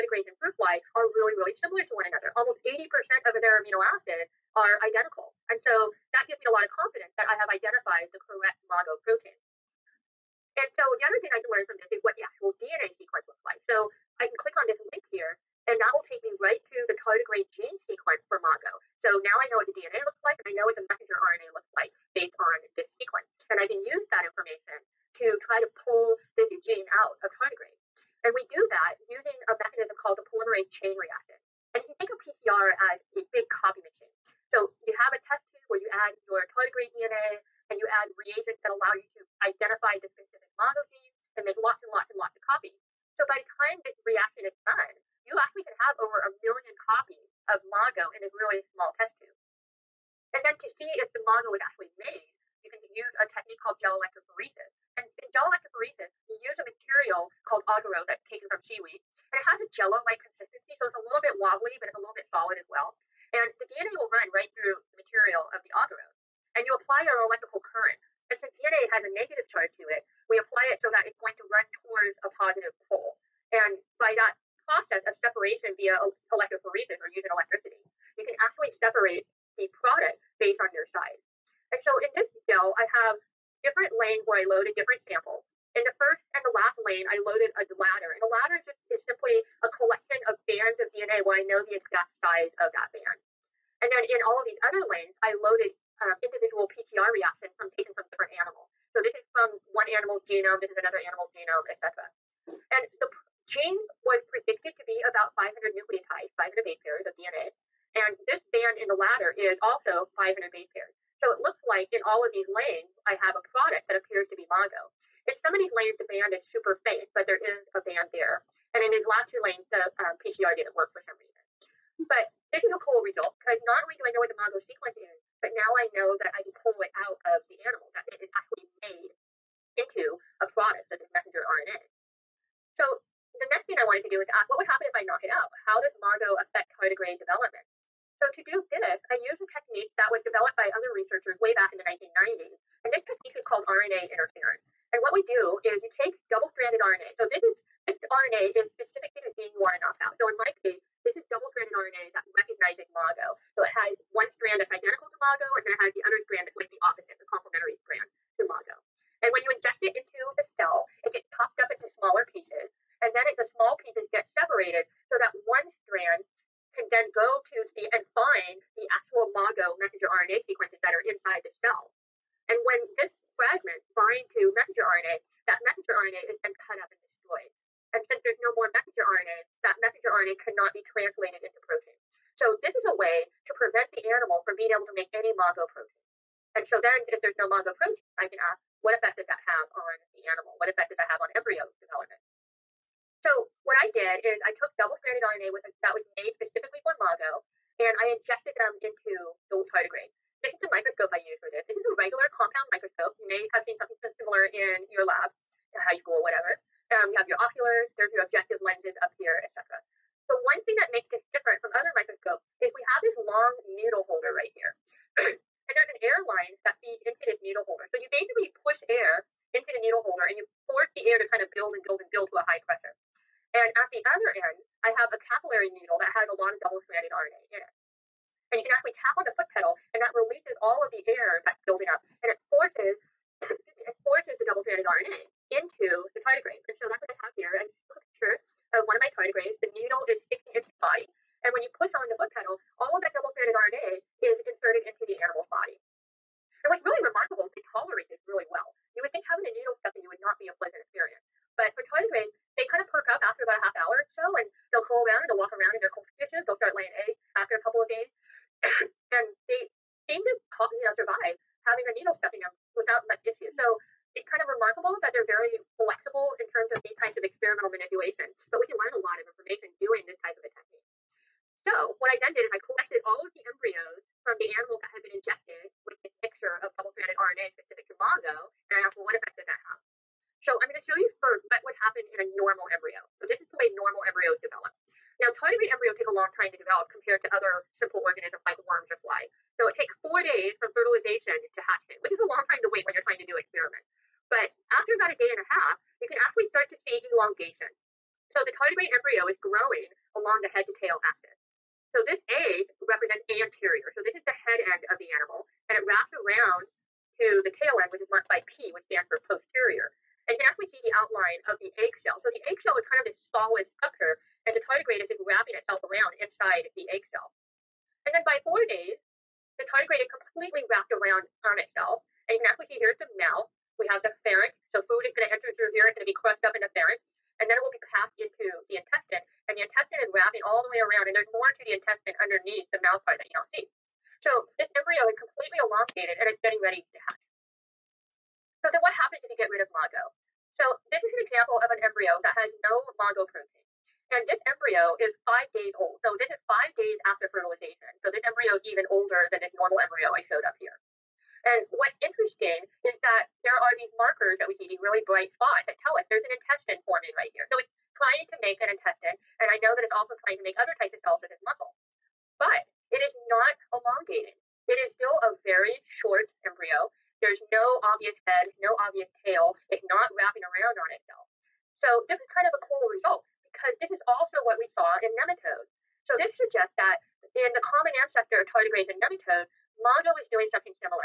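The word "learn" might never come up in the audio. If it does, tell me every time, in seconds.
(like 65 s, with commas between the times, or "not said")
11 s, 268 s.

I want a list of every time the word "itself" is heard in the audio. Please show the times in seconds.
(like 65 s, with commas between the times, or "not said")
315 s, 321 s, 370 s.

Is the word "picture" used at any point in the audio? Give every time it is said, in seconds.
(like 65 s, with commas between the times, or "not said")
238 s.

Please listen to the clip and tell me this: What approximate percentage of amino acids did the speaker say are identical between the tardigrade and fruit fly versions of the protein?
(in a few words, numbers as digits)
80%.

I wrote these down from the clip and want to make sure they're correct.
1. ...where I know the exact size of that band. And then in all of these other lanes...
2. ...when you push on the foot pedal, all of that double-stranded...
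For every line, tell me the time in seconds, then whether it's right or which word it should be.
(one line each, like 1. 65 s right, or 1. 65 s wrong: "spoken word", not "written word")
1. 91 s right
2. 241 s right.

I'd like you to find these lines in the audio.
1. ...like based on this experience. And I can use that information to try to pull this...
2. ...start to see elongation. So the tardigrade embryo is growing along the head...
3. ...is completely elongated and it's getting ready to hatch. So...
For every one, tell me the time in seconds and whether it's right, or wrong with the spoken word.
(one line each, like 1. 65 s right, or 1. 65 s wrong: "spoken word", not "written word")
1. 21 s wrong: "sequence", not "experience"
2. 296 s right
3. 335 s right.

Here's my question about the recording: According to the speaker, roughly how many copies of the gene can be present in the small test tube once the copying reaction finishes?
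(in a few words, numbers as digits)
over a million.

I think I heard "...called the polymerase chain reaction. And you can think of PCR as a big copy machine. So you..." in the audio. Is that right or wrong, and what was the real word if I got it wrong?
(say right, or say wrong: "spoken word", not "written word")
right.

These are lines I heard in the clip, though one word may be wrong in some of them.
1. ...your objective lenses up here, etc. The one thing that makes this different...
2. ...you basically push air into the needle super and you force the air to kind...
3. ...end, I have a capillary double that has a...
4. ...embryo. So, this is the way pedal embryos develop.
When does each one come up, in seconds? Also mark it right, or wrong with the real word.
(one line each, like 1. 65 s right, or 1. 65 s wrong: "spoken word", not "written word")
1. 208 s right
2. 217 s wrong: "holder", not "super"
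3. 224 s wrong: "needle", not "double"
4. 282 s wrong: "normal", not "pedal".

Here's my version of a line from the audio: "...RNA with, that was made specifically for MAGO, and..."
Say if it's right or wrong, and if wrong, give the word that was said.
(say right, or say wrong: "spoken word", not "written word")
right.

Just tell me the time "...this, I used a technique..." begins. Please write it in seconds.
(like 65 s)
138 s.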